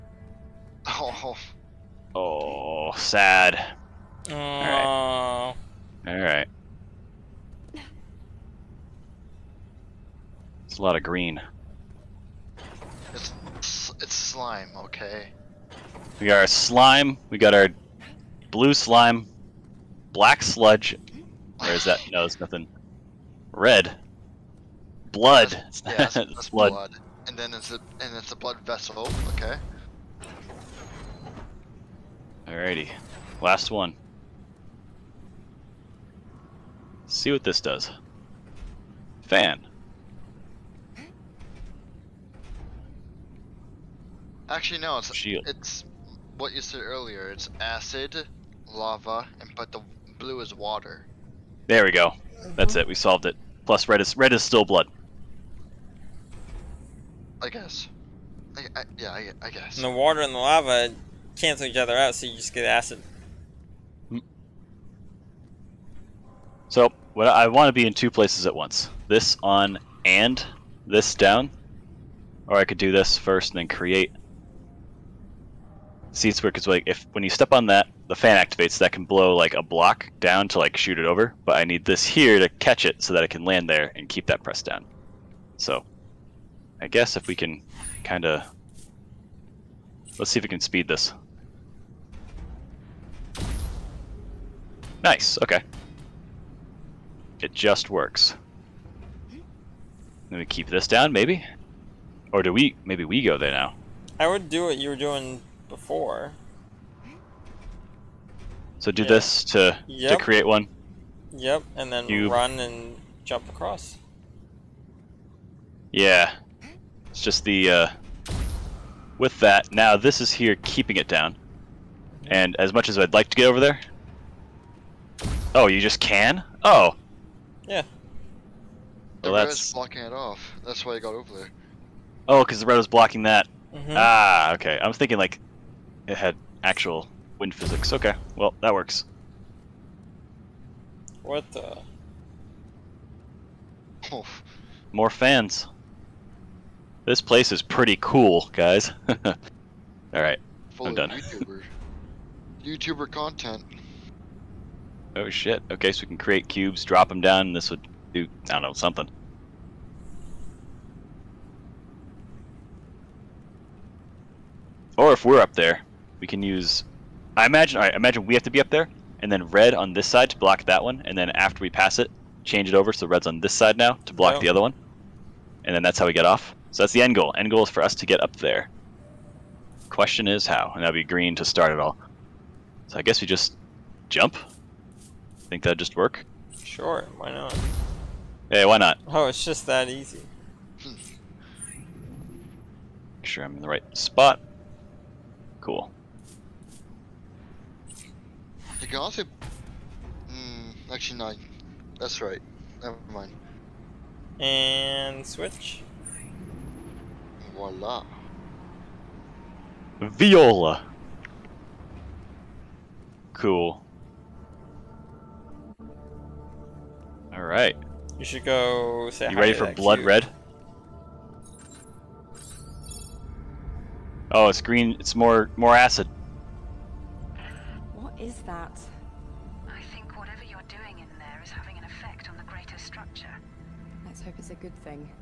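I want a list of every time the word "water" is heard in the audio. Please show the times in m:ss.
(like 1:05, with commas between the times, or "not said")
0:50, 0:59.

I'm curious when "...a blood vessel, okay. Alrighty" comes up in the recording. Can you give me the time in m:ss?
0:28.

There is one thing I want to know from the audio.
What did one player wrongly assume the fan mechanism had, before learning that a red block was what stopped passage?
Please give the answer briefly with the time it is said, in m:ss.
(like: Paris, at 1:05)
Actual wind physics, at 2:16.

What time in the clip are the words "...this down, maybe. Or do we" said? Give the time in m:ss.
1:40.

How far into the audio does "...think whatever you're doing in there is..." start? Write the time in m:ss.
3:49.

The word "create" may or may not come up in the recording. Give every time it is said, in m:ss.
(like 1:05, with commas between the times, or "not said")
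1:13, 1:50, 2:36.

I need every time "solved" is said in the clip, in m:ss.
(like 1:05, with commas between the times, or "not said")
0:52.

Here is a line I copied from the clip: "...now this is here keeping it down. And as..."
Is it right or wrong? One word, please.
right.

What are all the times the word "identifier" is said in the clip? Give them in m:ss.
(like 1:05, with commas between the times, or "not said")
not said.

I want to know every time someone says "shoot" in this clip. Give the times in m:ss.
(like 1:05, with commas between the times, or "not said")
1:20.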